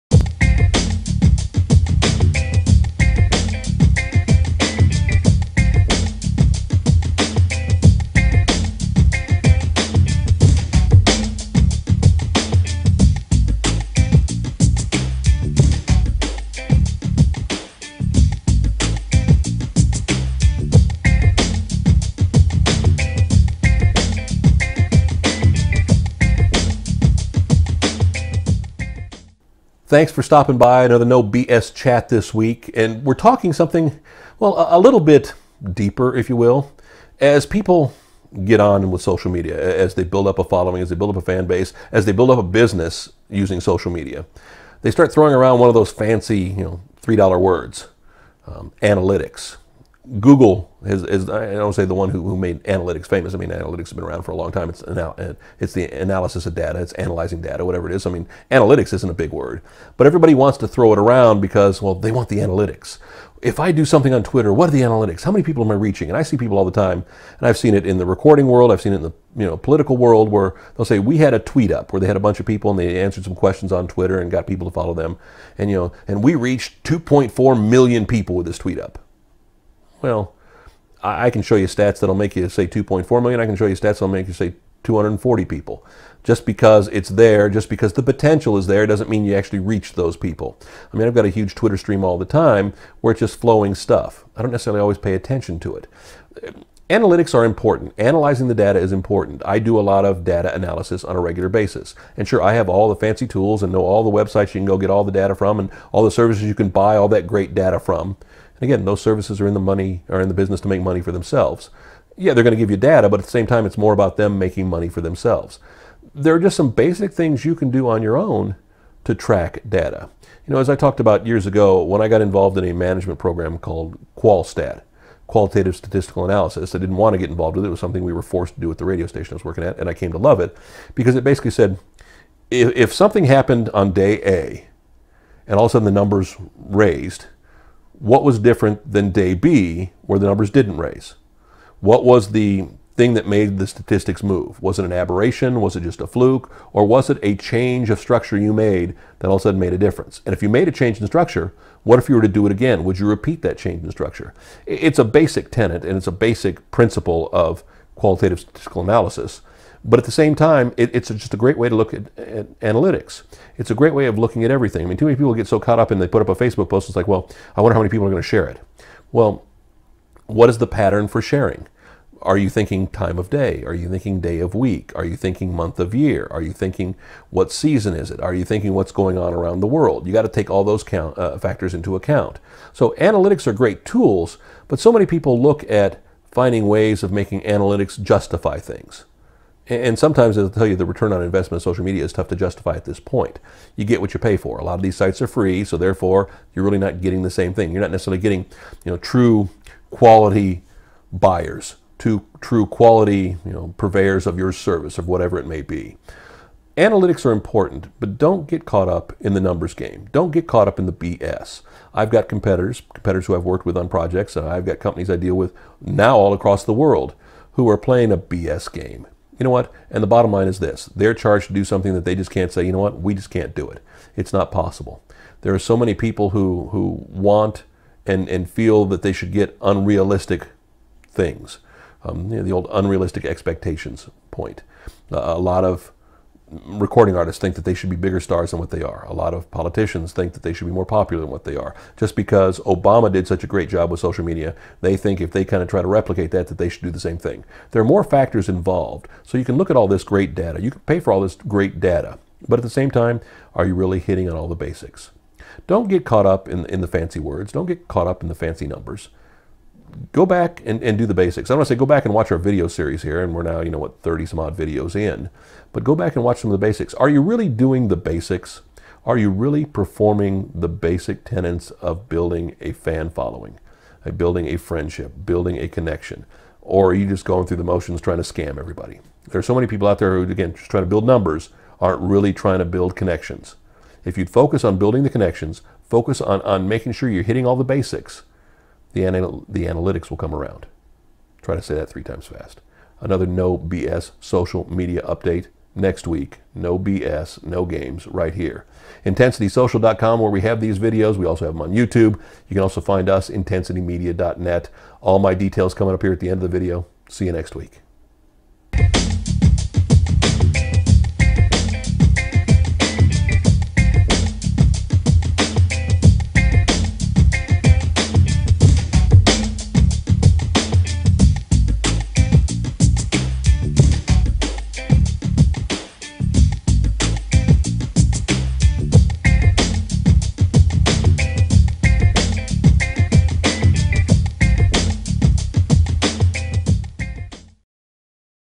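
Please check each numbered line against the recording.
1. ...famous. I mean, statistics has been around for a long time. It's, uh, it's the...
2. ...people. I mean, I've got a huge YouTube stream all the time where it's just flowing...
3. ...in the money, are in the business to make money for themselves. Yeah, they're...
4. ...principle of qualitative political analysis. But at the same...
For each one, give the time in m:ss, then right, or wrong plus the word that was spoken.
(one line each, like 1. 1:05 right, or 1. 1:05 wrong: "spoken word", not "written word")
1. 0:53 wrong: "analytics", not "statistics"
2. 1:30 wrong: "Twitter", not "YouTube"
3. 1:49 right
4. 2:36 wrong: "statistical", not "political".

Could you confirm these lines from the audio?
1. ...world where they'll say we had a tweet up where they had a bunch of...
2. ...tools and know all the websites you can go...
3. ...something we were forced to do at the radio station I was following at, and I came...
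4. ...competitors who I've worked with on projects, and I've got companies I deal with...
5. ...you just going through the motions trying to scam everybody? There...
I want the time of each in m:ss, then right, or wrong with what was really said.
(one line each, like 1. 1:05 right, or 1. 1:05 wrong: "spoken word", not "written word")
1. 1:09 right
2. 1:43 right
3. 2:07 wrong: "working", not "following"
4. 3:32 right
5. 4:36 right.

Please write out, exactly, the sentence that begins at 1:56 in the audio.
There are just some basic things you can do on your own to track data.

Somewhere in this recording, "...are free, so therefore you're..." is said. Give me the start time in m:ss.
3:15.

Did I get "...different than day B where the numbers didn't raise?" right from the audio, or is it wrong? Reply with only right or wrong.
right.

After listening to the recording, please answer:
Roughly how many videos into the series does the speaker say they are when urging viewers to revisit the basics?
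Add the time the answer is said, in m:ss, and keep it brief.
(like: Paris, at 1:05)
30 some odd, at 4:24.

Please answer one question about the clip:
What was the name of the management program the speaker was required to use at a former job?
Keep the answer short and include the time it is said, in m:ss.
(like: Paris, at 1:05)
QualStat, at 2:04.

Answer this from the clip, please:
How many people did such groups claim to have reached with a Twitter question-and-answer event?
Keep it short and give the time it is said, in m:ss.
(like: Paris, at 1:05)
2.4 million, at 1:16.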